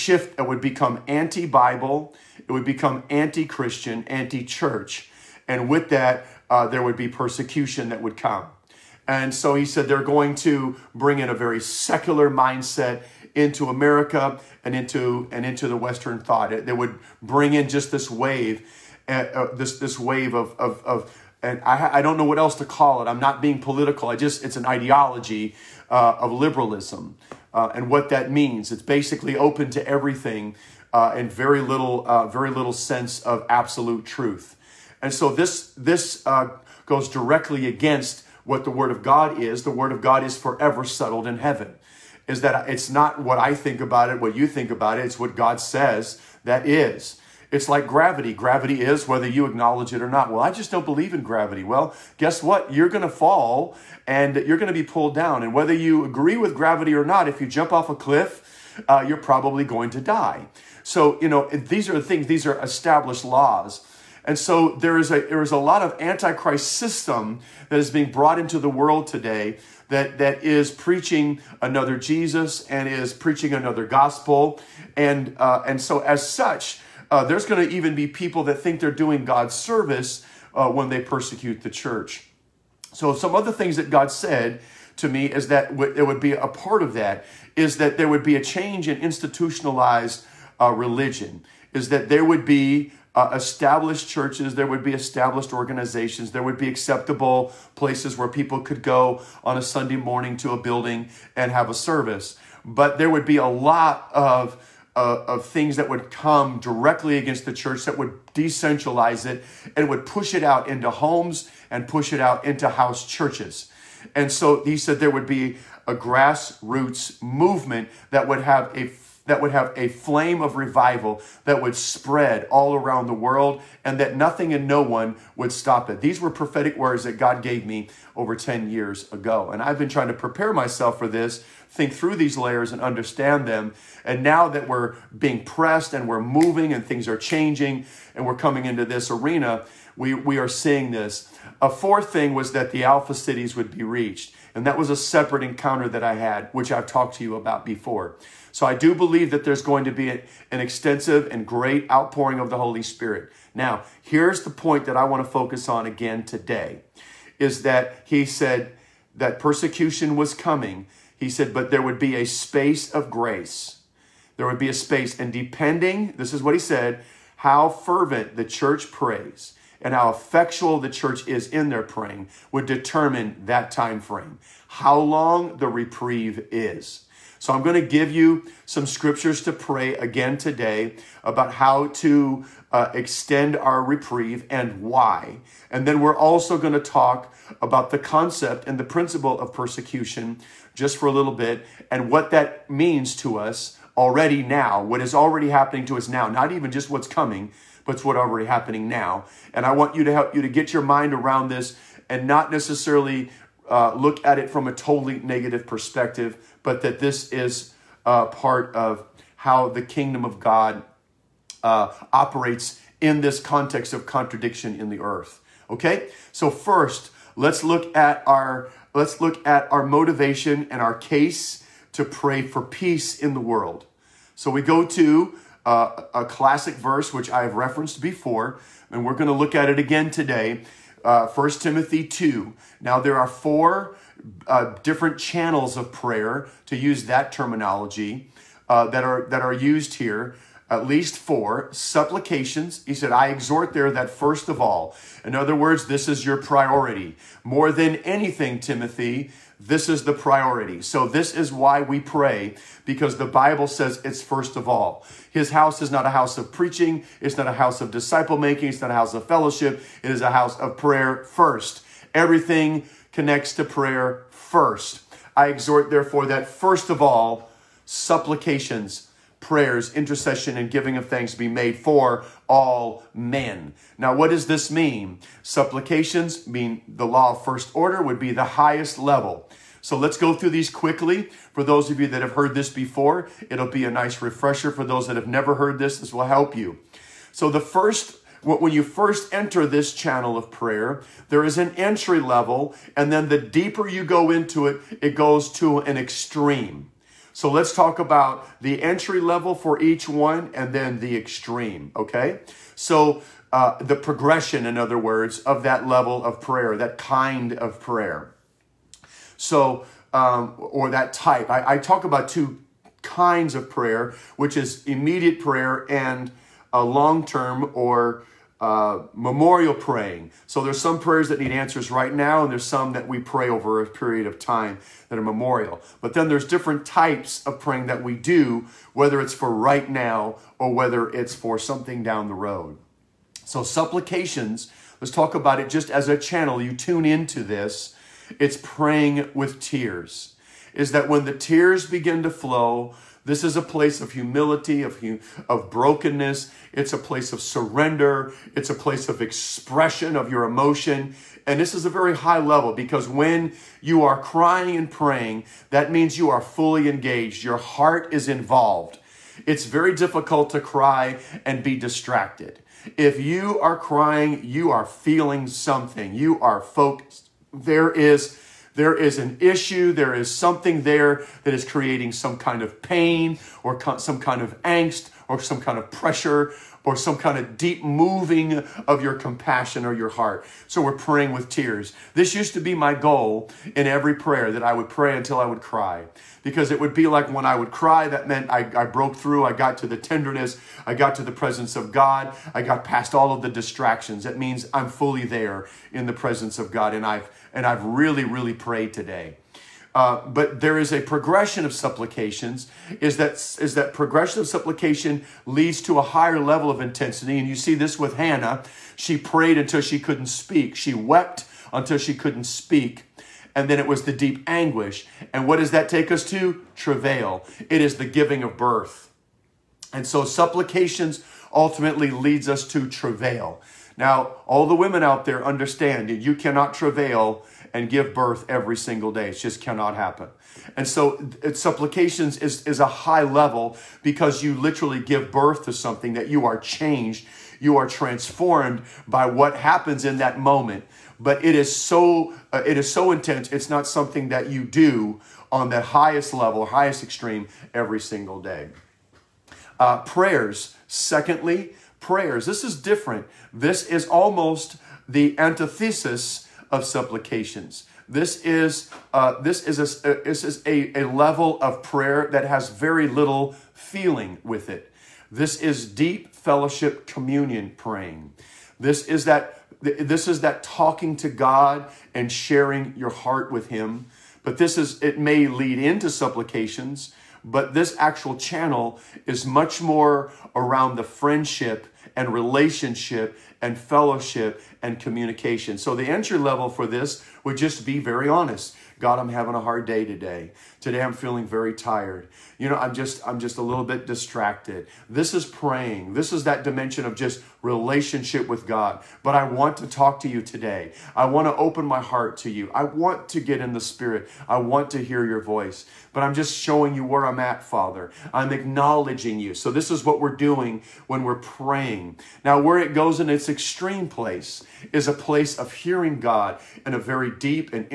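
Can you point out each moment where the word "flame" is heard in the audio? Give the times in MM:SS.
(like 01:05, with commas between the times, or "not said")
01:59.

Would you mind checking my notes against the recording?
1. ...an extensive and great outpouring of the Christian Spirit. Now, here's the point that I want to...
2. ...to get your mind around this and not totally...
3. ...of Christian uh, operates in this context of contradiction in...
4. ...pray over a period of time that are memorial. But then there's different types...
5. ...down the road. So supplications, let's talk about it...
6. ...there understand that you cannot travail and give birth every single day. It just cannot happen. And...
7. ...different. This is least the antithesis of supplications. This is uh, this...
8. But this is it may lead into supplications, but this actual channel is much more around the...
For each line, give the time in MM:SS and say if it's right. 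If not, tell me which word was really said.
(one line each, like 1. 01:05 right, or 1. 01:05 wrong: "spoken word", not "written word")
1. 02:30 wrong: "Holy", not "Christian"
2. 03:20 wrong: "necessarily", not "totally"
3. 03:30 wrong: "God", not "Christian"
4. 05:23 right
5. 05:32 right
6. 07:05 right
7. 07:32 wrong: "almost", not "least"
8. 07:54 right.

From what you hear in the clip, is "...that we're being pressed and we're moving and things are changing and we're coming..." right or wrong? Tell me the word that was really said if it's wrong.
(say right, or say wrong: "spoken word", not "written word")
right.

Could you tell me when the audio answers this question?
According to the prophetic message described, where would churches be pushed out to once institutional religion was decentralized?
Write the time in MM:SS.
01:52.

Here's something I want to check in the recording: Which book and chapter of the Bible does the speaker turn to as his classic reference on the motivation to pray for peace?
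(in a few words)
1 Timothy 2.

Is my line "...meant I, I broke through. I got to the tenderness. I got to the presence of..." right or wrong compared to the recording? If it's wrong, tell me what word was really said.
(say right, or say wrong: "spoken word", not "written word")
right.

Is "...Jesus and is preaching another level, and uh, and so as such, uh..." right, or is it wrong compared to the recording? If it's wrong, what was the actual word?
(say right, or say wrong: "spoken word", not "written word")
wrong: "gospel", not "level".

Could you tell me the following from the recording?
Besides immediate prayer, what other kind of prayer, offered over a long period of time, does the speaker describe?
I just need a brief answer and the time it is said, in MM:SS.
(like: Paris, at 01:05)
Memorial praying, at 05:19.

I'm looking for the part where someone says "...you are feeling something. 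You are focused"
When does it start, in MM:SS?
06:04.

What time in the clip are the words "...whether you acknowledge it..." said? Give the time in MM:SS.
00:49.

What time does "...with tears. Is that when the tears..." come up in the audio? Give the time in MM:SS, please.
05:39.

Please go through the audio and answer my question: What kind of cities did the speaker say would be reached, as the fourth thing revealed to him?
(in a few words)
Alpha cities.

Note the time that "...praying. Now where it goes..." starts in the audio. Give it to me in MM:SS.
08:31.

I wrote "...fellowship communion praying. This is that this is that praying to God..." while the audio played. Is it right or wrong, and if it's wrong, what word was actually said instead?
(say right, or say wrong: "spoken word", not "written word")
wrong: "talking", not "praying".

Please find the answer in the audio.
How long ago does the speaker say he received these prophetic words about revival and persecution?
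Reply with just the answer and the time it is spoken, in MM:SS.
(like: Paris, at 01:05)
Over 10 years ago, at 02:08.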